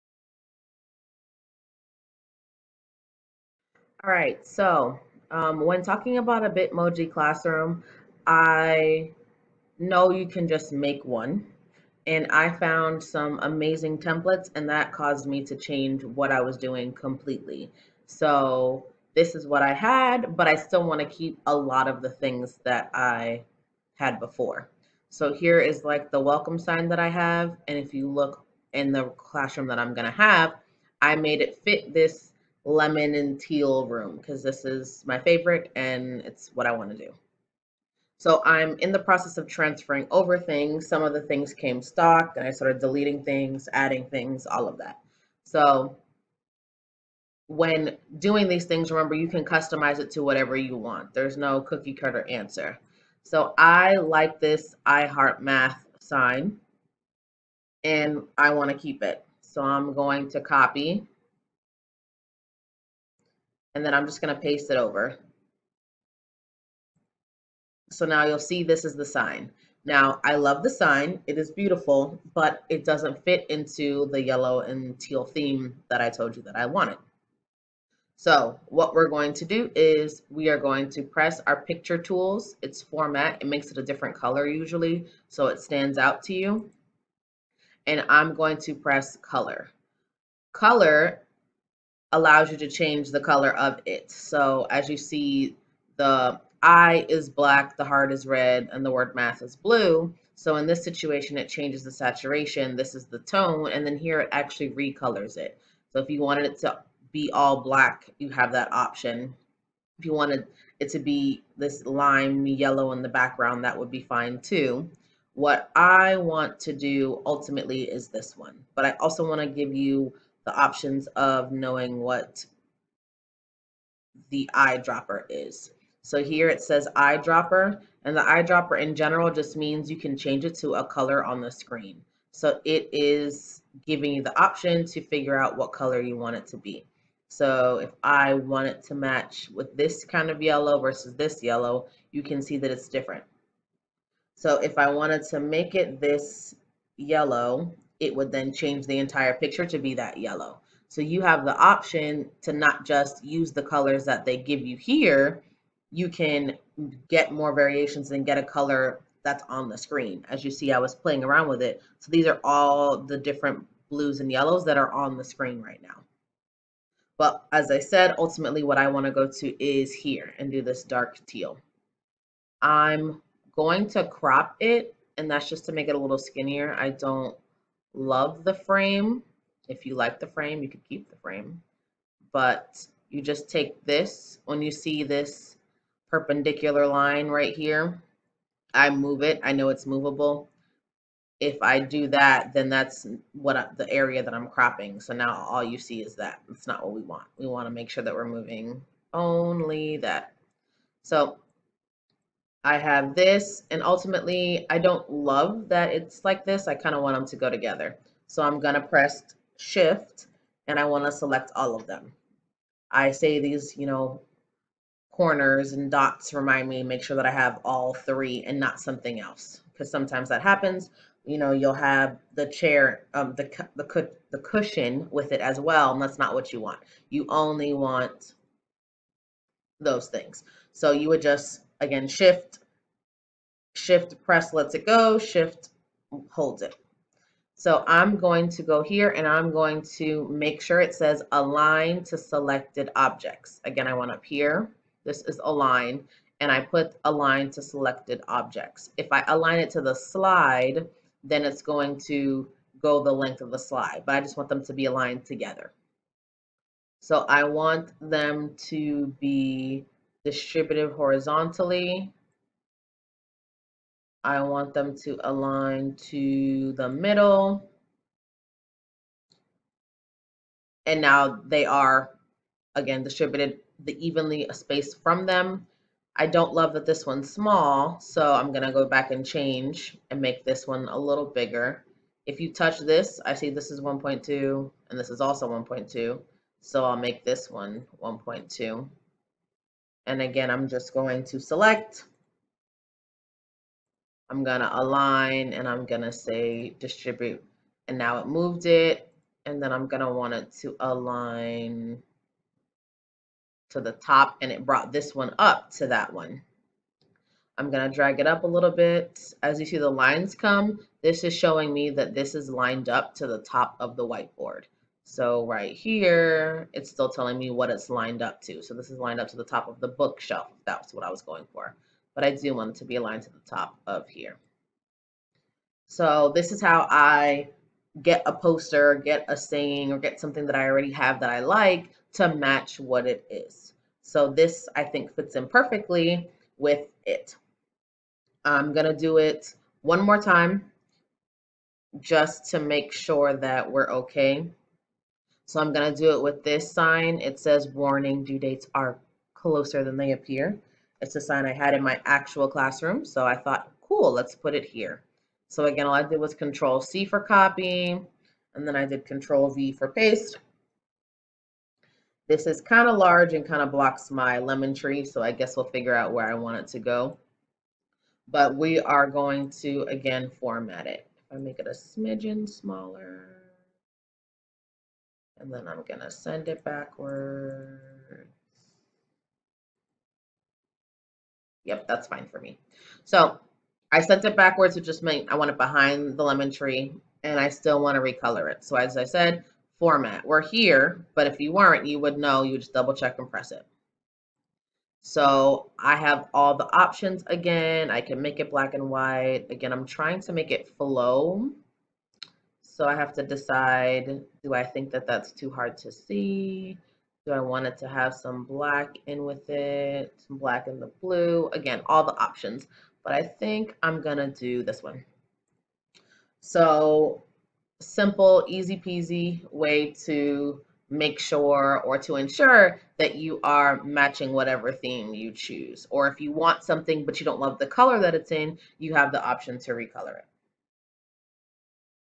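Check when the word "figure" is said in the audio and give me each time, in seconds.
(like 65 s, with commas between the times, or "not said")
135 s, 365 s.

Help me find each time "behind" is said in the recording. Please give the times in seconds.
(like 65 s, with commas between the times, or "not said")
385 s.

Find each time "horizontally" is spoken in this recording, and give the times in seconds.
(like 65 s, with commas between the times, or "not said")
260 s.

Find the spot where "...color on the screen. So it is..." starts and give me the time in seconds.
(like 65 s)
130 s.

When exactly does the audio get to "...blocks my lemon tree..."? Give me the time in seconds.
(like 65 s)
363 s.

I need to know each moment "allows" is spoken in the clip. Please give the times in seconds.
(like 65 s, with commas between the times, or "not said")
92 s.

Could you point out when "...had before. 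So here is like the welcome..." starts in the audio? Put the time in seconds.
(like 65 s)
23 s.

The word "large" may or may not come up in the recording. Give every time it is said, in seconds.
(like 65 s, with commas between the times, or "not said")
362 s.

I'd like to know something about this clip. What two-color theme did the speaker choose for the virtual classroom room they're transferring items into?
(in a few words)
lemon and teal.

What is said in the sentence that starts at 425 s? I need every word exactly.
Or if you want something but you don't love the color that it's in, you have the option to recolor it.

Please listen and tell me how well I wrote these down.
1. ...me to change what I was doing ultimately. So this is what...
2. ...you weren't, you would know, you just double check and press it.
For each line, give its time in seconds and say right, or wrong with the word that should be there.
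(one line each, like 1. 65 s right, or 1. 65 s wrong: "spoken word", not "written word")
1. 15 s wrong: "completely", not "ultimately"
2. 391 s right.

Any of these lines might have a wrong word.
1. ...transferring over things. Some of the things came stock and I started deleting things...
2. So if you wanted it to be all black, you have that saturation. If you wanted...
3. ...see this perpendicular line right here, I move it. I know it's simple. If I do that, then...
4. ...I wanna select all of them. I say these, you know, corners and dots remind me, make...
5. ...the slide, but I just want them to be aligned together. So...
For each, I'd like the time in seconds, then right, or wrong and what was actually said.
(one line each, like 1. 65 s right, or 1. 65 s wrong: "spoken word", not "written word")
1. 39 s right
2. 105 s wrong: "option", not "saturation"
3. 184 s wrong: "movable", not "simple"
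4. 210 s right
5. 253 s right.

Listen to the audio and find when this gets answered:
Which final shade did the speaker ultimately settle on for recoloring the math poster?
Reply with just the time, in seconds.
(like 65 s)
170 s.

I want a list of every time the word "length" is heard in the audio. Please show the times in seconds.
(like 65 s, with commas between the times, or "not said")
253 s.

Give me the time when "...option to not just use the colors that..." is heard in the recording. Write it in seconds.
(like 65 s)
151 s.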